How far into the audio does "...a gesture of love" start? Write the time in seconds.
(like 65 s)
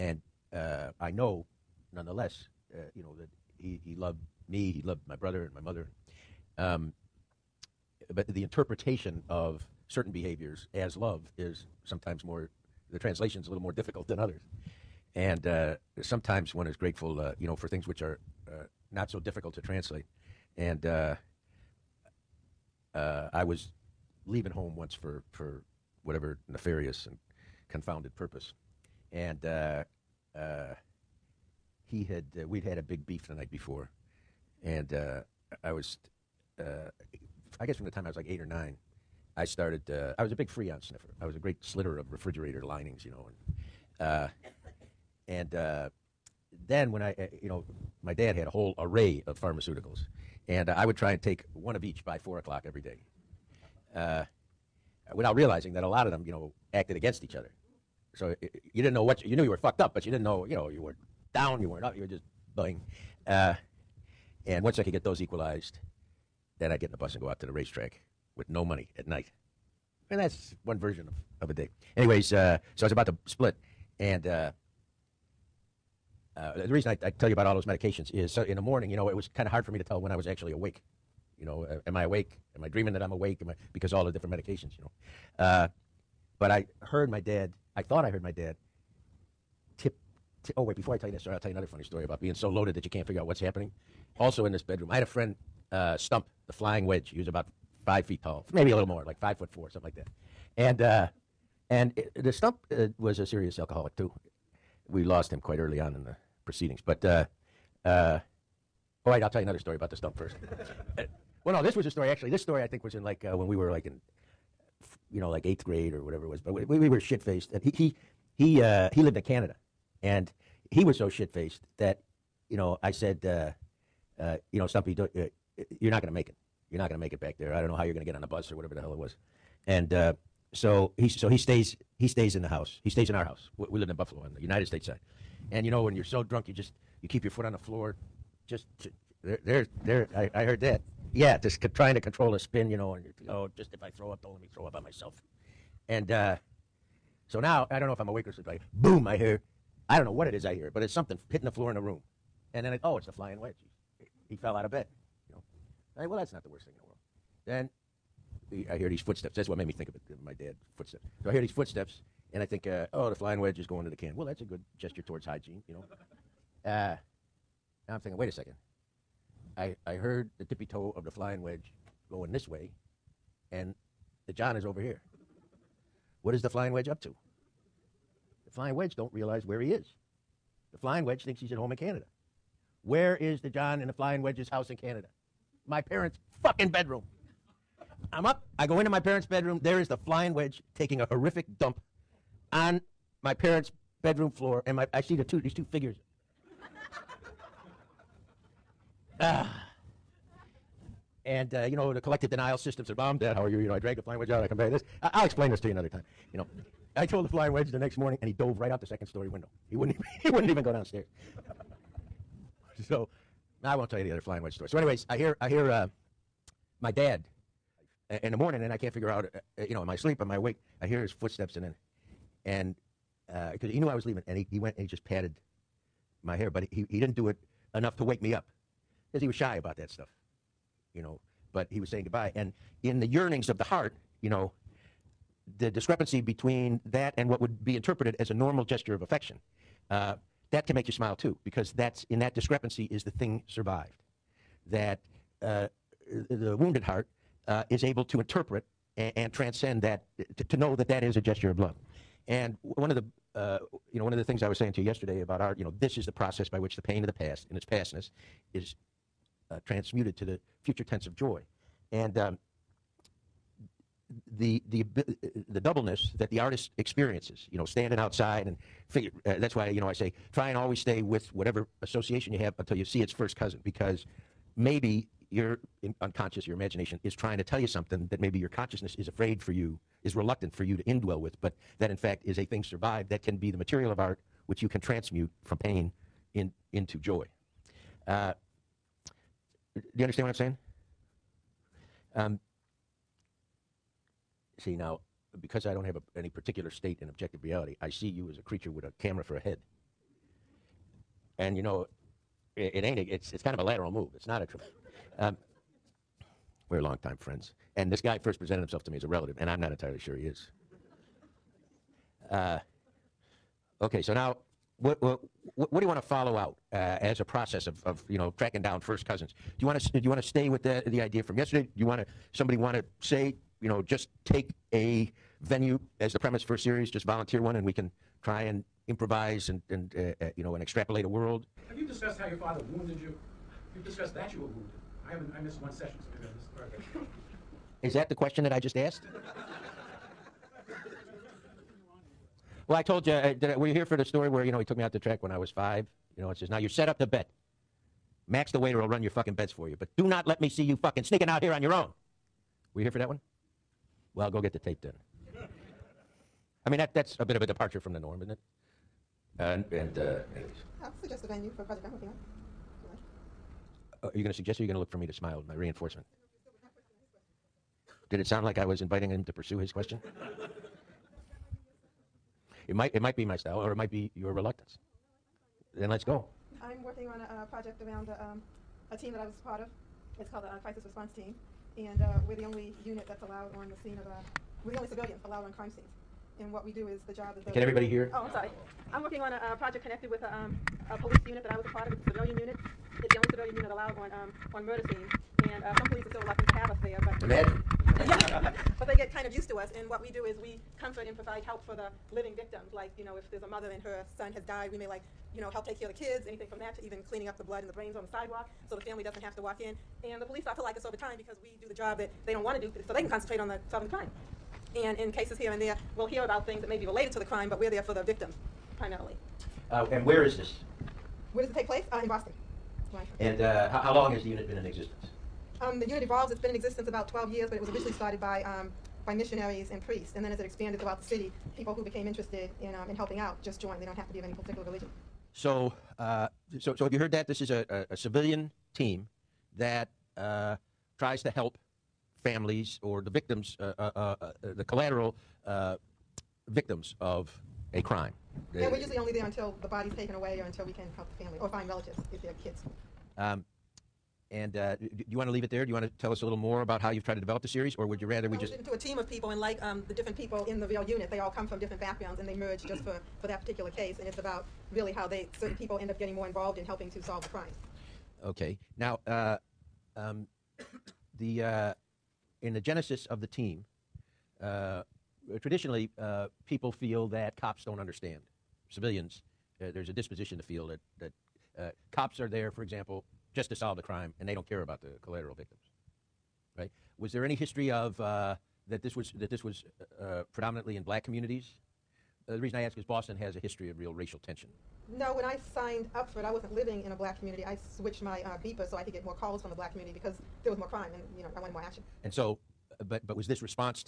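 251 s.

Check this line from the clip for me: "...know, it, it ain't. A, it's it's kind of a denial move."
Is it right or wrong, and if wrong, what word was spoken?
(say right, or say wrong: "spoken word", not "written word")
wrong: "lateral", not "denial".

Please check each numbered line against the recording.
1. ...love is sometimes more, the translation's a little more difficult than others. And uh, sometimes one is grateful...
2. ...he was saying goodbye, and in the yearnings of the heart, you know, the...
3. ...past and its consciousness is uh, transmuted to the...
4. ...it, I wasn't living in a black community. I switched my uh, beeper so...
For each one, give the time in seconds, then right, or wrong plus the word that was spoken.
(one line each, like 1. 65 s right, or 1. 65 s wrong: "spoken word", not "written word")
1. 10 s right
2. 231 s right
3. 257 s wrong: "pastness", not "consciousness"
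4. 496 s right.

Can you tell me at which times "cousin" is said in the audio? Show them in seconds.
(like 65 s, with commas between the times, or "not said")
273 s, 319 s.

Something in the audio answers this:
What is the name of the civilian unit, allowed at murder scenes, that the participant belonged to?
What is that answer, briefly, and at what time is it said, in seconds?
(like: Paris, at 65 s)
Crisis Response Team, at 380 s.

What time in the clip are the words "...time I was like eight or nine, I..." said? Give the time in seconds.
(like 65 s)
37 s.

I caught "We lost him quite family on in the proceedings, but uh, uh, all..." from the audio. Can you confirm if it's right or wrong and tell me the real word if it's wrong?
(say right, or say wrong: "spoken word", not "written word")
wrong: "early", not "family".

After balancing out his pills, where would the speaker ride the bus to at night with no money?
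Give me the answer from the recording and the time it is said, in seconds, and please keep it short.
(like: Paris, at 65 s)
the racetrack, at 67 s.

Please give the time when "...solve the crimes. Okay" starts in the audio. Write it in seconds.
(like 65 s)
467 s.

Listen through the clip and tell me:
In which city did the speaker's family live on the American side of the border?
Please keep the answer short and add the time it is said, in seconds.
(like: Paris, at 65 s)
Buffalo, at 133 s.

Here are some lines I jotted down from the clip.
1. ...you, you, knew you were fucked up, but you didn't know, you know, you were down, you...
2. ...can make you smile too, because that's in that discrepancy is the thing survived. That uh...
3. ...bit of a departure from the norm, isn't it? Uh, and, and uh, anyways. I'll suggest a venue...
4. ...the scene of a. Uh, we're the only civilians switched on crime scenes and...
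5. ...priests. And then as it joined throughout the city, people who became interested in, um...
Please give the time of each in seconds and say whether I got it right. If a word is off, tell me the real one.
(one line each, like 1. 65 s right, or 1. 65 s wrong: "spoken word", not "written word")
1. 59 s right
2. 240 s right
3. 357 s right
4. 383 s wrong: "allowed", not "switched"
5. 429 s wrong: "expanded", not "joined".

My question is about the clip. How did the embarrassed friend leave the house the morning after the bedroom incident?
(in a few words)
second story window.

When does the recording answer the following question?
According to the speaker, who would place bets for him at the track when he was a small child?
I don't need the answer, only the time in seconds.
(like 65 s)
348 s.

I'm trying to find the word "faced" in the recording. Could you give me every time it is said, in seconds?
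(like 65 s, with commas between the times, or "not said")
117 s, 121 s.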